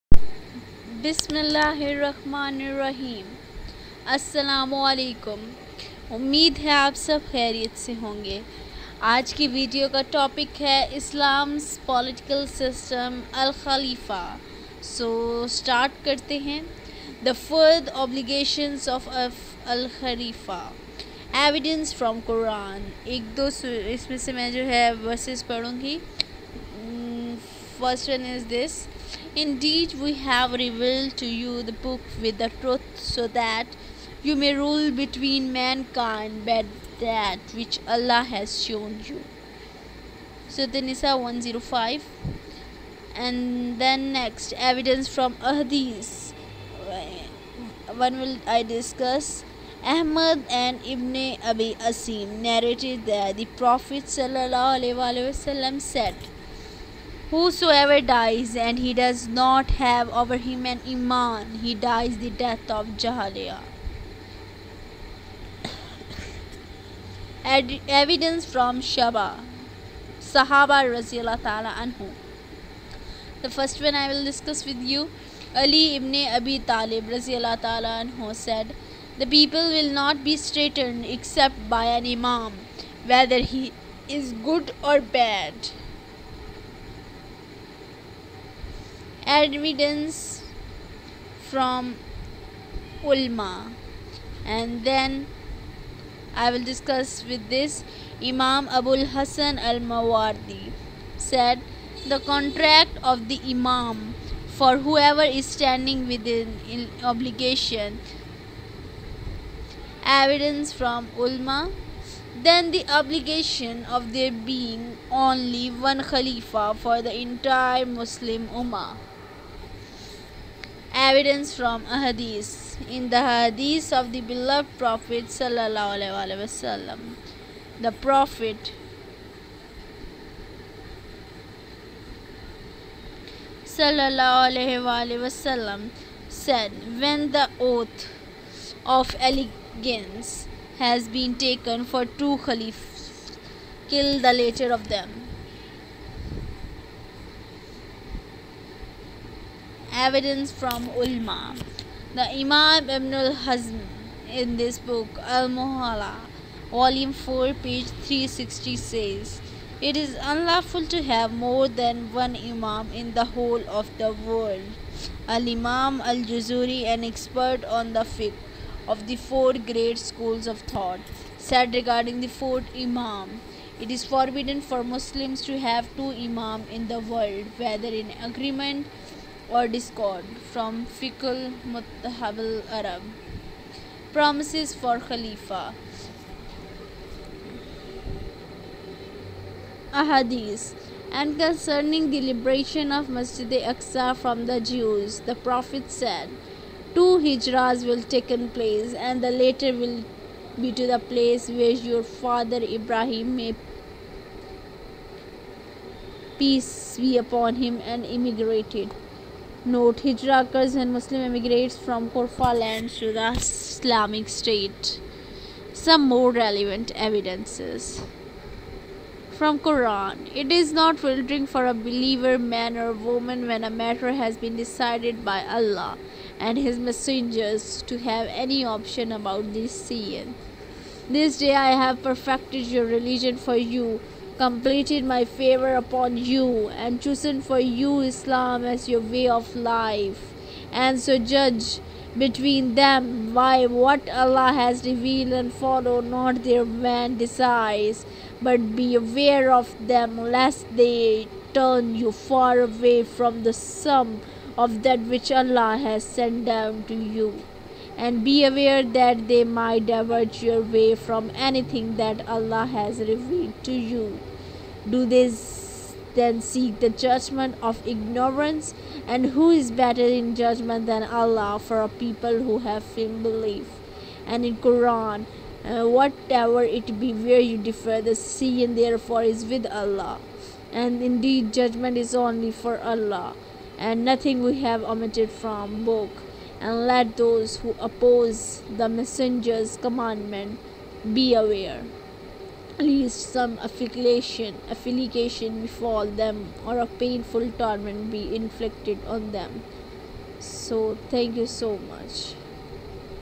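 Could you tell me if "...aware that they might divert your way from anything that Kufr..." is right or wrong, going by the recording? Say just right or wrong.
wrong.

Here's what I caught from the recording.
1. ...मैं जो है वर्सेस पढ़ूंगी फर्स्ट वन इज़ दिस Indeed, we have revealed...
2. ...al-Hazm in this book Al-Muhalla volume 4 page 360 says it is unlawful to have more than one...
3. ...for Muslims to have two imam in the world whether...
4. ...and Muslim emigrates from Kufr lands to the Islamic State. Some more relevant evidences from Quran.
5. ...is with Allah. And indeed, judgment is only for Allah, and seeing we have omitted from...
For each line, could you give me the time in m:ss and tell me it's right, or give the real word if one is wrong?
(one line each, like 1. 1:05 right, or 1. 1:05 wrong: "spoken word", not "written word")
1. 0:24 right
2. 2:33 right
3. 2:54 right
4. 3:30 right
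5. 4:39 wrong: "nothing", not "seeing".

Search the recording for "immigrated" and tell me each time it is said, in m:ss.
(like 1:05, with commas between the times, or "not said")
3:28.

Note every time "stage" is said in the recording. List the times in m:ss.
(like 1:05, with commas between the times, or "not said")
not said.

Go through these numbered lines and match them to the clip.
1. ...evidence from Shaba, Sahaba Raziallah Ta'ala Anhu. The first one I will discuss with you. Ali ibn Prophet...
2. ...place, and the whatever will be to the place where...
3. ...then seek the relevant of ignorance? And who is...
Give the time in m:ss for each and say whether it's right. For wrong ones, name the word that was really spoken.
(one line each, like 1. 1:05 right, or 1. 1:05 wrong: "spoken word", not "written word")
1. 1:07 wrong: "Abi", not "Prophet"
2. 3:18 wrong: "latter", not "whatever"
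3. 4:26 wrong: "judgment", not "relevant".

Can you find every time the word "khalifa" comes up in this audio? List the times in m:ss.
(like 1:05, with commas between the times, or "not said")
1:56, 3:04.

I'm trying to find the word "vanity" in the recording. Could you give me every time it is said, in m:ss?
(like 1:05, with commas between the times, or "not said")
not said.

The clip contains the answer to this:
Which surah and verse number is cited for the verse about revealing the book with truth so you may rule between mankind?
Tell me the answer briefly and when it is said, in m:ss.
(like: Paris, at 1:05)
An-Nisa 105, at 0:40.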